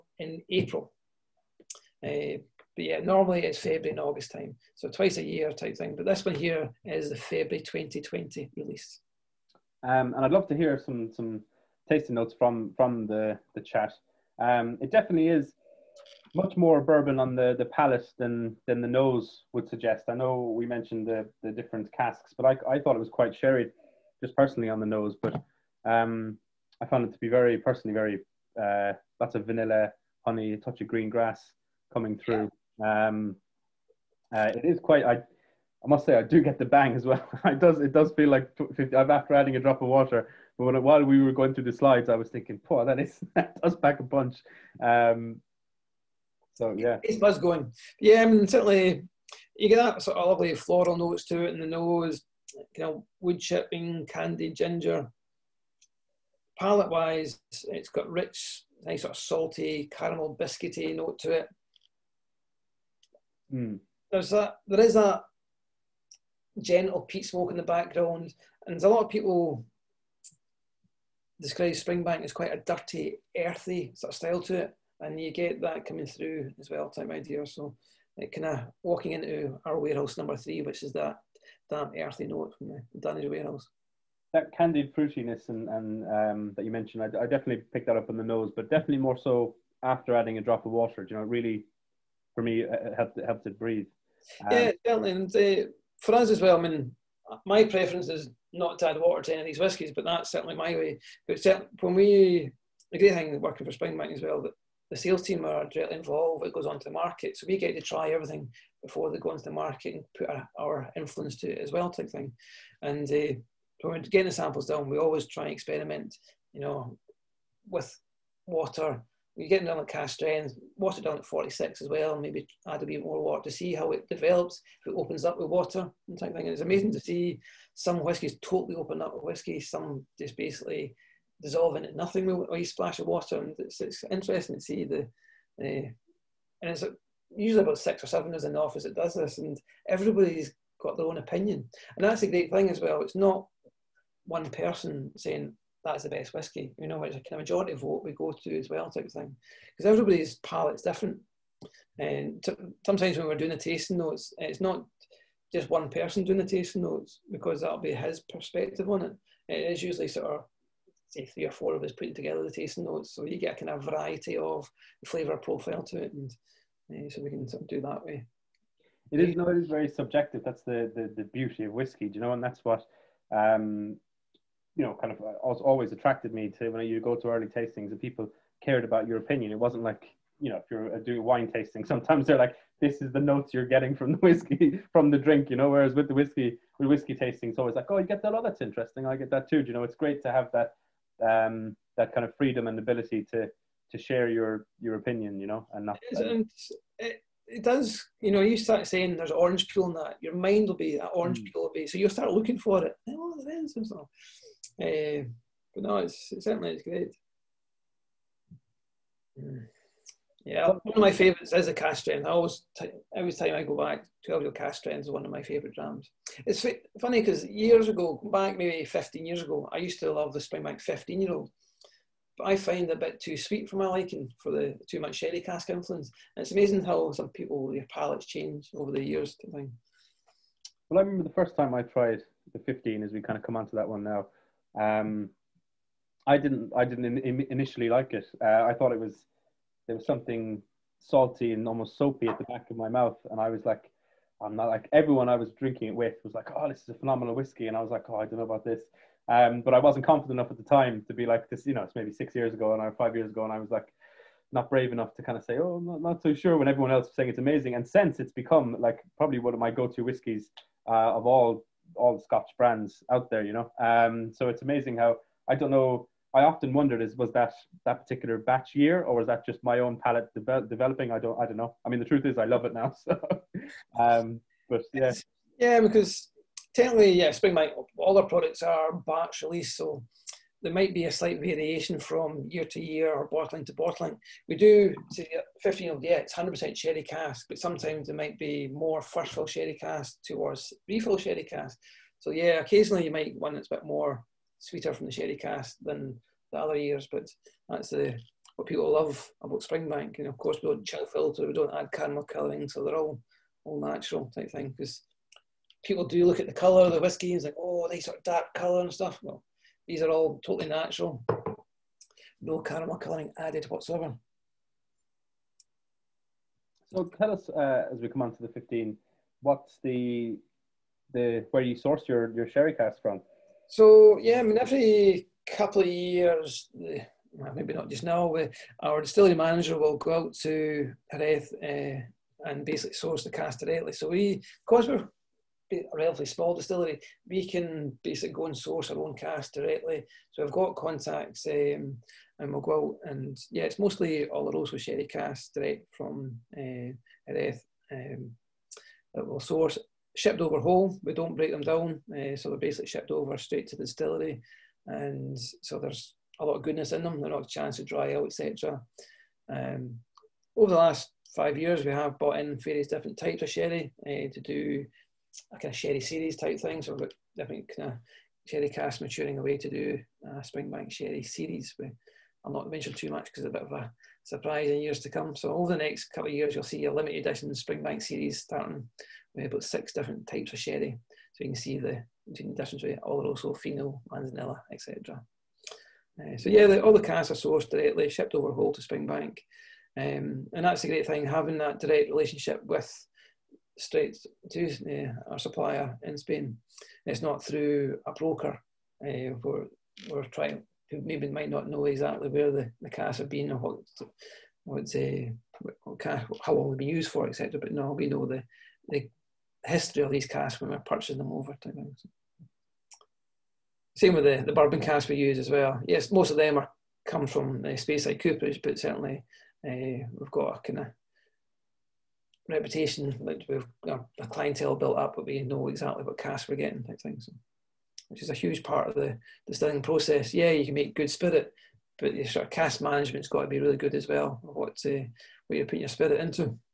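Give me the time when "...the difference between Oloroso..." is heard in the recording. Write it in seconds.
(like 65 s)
382 s.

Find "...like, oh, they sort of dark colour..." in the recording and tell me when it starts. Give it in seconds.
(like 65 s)
307 s.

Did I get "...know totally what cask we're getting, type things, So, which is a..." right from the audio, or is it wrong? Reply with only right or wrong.
wrong.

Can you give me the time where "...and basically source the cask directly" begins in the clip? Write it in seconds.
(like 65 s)
332 s.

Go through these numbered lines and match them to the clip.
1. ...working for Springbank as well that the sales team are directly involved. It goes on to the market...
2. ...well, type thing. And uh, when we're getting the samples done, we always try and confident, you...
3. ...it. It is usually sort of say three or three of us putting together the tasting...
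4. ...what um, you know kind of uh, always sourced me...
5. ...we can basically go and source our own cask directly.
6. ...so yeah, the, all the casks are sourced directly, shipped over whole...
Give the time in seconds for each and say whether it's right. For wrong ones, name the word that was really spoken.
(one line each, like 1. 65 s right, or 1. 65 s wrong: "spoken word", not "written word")
1. 103 s right
2. 111 s wrong: "experiment", not "confident"
3. 159 s wrong: "four", not "three"
4. 172 s wrong: "attracted", not "sourced"
5. 337 s right
6. 386 s right.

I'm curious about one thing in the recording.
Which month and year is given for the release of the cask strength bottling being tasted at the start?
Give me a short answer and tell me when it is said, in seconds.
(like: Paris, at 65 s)
February 2020, at 7 s.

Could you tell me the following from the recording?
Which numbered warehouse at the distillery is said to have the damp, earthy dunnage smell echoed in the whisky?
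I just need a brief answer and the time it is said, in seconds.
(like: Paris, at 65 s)
Warehouse number three, at 79 s.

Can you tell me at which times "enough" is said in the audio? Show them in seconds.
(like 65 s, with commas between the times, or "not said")
250 s, 254 s.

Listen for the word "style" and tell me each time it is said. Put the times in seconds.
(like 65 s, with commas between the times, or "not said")
74 s.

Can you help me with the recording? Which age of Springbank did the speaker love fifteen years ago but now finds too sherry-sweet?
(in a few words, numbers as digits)
15 year old.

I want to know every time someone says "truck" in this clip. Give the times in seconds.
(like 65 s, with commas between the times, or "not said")
not said.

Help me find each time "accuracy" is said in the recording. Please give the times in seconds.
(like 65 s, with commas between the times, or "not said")
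not said.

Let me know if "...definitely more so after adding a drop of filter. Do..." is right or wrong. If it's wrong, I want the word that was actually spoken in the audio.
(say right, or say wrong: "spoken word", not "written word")
wrong: "water", not "filter".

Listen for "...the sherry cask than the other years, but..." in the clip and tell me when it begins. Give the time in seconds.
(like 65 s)
295 s.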